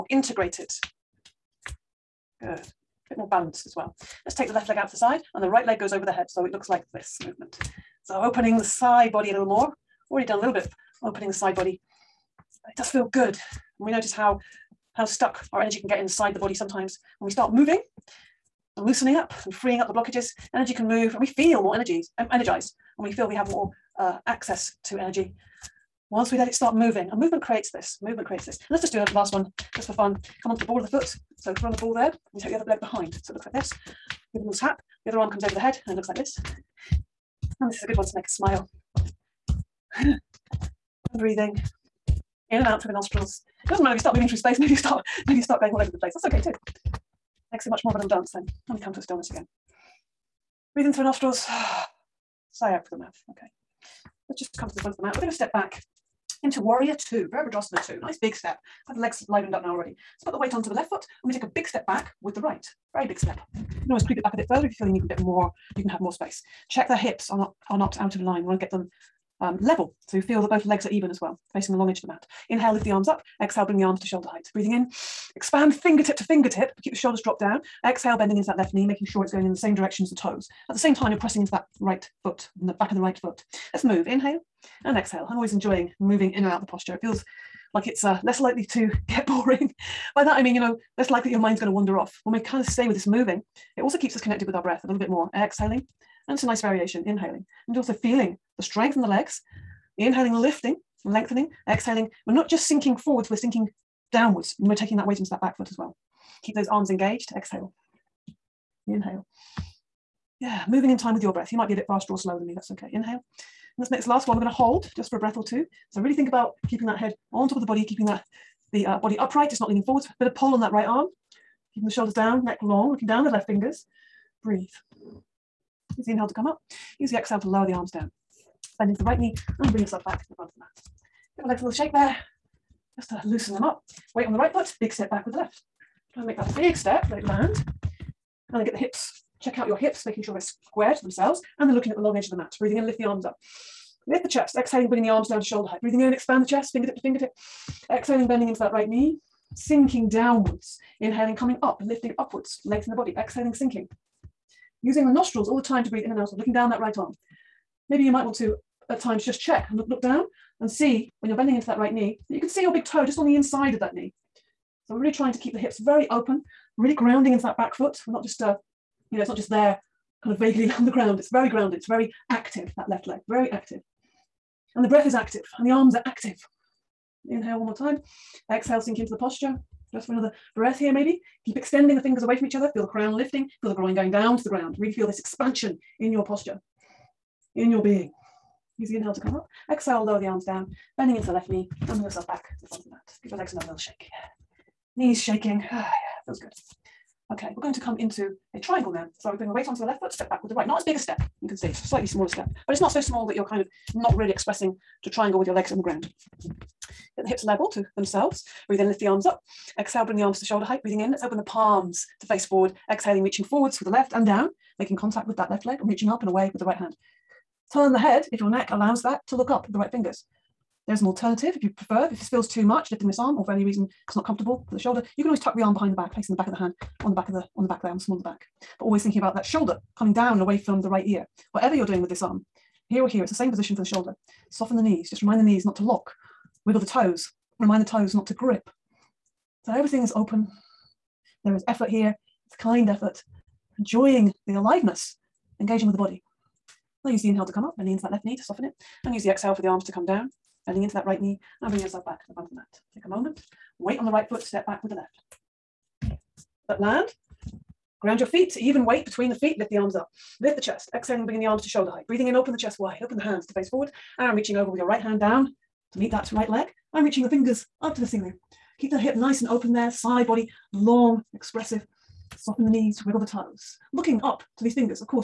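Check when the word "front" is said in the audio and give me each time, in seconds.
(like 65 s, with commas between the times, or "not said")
54 s, 130 s, 192 s, 252 s.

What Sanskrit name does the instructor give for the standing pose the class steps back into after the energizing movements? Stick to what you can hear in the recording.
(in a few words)
Virabhadrasana Two.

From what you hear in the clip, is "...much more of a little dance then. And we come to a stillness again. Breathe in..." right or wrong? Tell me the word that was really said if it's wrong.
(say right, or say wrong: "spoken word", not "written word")
right.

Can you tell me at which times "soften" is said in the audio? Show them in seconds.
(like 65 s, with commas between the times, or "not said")
234 s, 248 s, 272 s.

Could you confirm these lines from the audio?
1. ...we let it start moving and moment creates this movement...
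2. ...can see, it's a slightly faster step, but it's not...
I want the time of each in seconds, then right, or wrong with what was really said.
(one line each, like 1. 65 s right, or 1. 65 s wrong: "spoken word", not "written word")
1. 26 s wrong: "movement", not "moment"
2. 201 s wrong: "smaller", not "faster".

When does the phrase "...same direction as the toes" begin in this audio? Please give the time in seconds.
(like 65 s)
79 s.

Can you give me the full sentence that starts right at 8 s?
So opening the side body a little more.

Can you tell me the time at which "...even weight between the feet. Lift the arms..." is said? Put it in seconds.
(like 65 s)
258 s.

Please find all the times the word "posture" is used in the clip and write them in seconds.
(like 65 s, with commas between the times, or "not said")
86 s, 179 s, 186 s.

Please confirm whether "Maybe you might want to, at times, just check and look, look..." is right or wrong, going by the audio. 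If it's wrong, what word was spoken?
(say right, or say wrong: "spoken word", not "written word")
right.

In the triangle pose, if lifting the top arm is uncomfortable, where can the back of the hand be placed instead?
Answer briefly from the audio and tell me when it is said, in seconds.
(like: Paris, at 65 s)
small of the back, at 227 s.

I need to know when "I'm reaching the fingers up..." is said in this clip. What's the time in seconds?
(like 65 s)
266 s.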